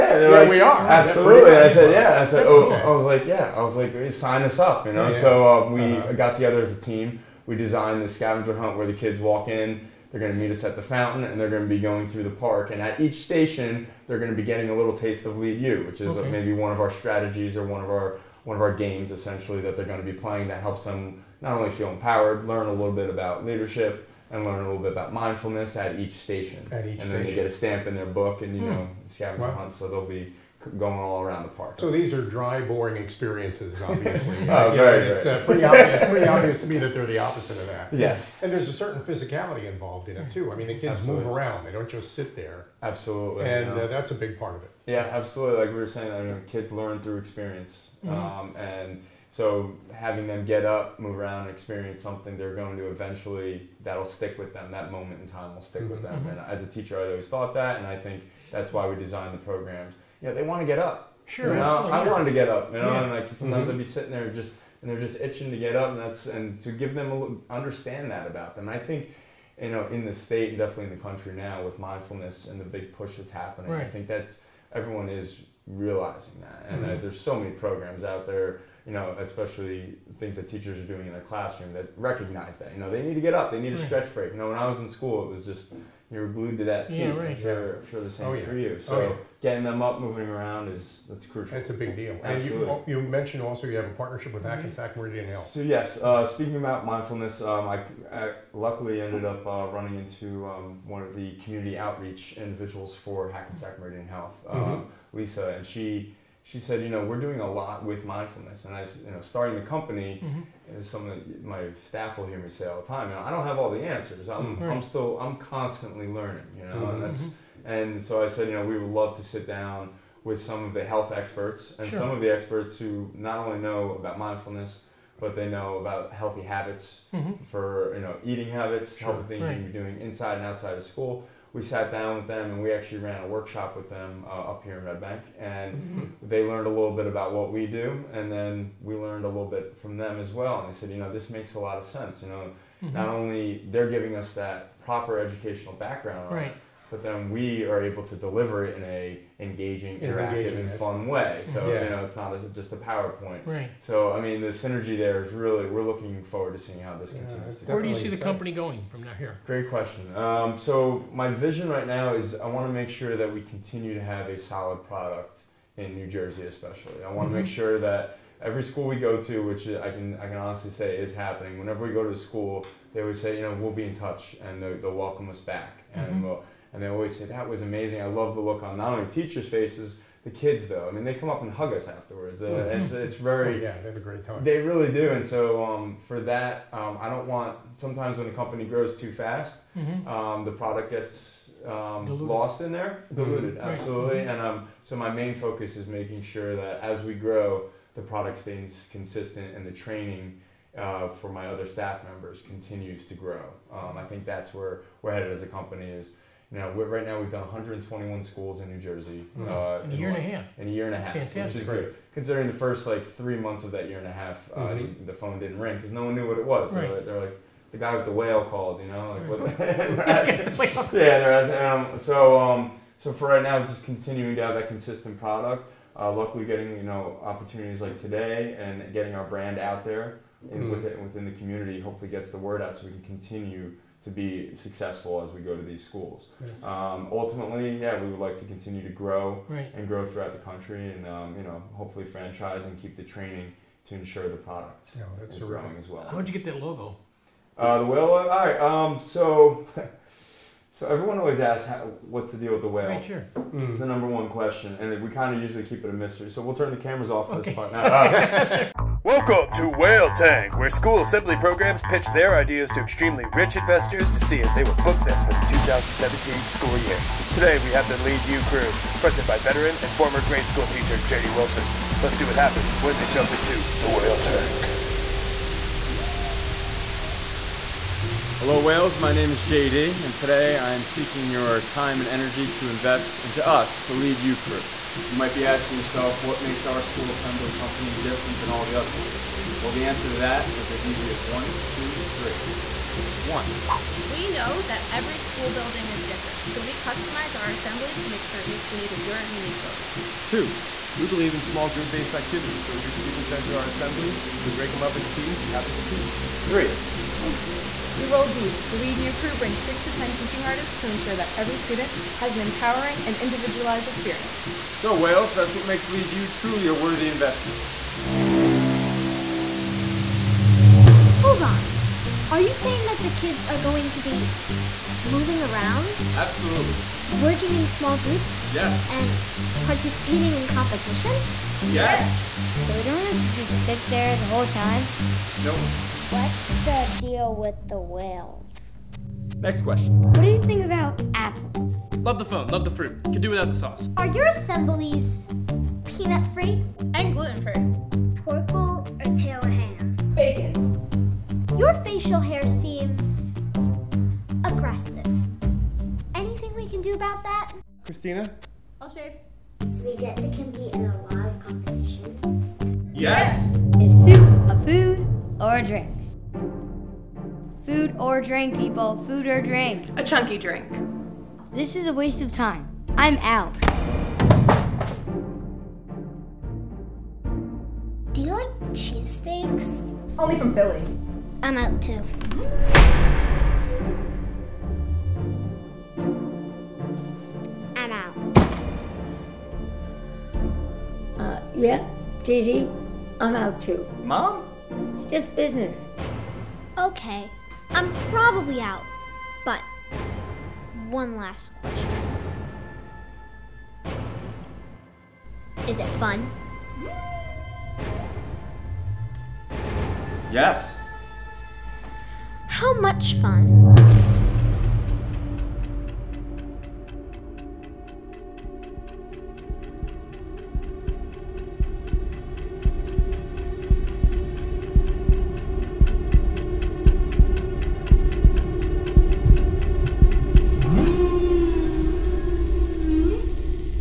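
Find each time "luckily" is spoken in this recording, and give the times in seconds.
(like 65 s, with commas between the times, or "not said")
98 s, 226 s.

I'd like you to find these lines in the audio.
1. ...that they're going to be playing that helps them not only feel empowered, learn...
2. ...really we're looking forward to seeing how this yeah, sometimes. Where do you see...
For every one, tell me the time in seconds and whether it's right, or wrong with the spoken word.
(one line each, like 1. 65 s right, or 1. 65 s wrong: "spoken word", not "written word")
1. 19 s right
2. 155 s wrong: "continues", not "sometimes".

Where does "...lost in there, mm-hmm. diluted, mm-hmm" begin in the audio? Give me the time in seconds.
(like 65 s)
192 s.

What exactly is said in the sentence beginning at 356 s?
Anything we can do about that?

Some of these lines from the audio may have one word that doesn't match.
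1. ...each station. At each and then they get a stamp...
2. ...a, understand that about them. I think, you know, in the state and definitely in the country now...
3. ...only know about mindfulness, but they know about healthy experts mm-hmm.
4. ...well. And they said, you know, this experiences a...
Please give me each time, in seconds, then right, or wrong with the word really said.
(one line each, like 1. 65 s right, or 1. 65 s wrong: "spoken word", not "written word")
1. 25 s right
2. 67 s right
3. 123 s wrong: "habits", not "experts"
4. 140 s wrong: "makes", not "experiences".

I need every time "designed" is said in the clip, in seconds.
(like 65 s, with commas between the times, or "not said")
7 s, 58 s.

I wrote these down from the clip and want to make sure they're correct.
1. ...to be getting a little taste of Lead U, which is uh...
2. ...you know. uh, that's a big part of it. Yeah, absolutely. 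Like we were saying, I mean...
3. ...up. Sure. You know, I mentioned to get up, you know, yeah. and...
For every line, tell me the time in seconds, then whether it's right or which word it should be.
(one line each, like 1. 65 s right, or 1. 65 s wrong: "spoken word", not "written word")
1. 14 s right
2. 43 s right
3. 60 s wrong: "wanted", not "mentioned".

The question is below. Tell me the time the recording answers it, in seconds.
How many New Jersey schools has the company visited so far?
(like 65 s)
207 s.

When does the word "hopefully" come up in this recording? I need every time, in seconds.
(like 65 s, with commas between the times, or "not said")
231 s, 241 s.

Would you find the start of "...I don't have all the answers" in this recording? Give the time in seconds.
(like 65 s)
113 s.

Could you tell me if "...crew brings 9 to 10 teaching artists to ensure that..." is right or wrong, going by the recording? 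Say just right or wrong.
wrong.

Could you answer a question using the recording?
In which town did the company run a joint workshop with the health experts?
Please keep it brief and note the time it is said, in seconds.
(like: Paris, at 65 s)
Red Bank, at 134 s.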